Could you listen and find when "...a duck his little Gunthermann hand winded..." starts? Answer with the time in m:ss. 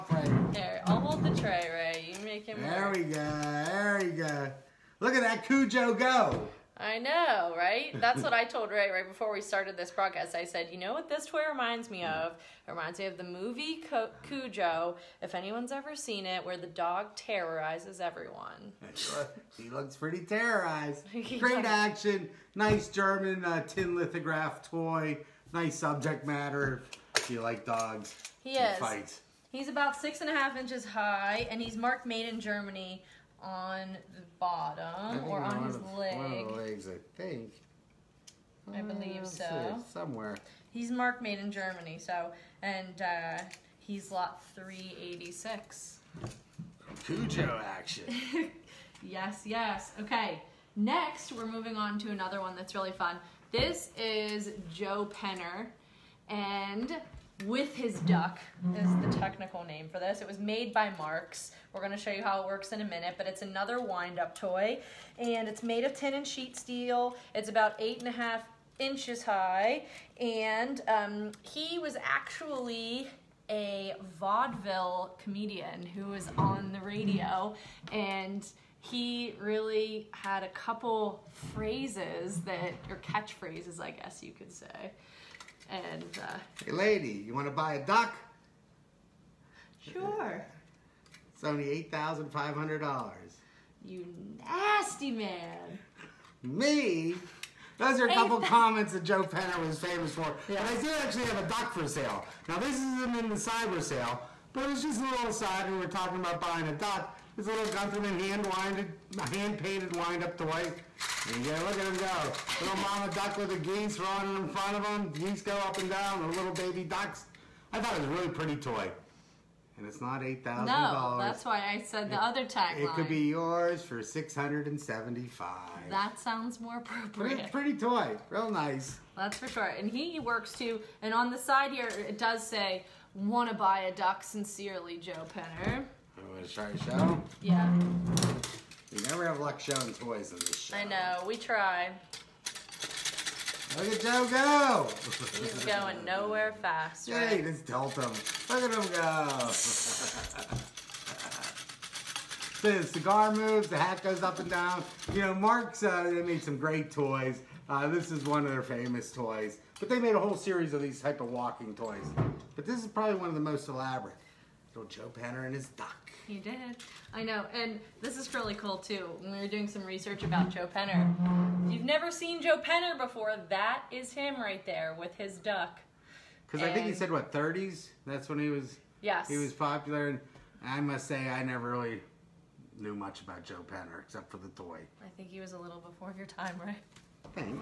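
1:46.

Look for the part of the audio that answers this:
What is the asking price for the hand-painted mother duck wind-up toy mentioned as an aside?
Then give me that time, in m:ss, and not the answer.
2:04.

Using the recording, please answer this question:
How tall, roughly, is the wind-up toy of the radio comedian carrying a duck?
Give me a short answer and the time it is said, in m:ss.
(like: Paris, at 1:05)
8.5 inches, at 1:07.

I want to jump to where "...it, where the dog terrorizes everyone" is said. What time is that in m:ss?
0:16.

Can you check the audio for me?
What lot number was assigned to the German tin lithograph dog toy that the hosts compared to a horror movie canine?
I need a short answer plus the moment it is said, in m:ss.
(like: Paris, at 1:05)
386, at 0:44.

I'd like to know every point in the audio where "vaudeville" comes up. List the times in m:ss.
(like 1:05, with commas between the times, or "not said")
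1:14.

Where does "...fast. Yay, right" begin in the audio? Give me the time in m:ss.
2:26.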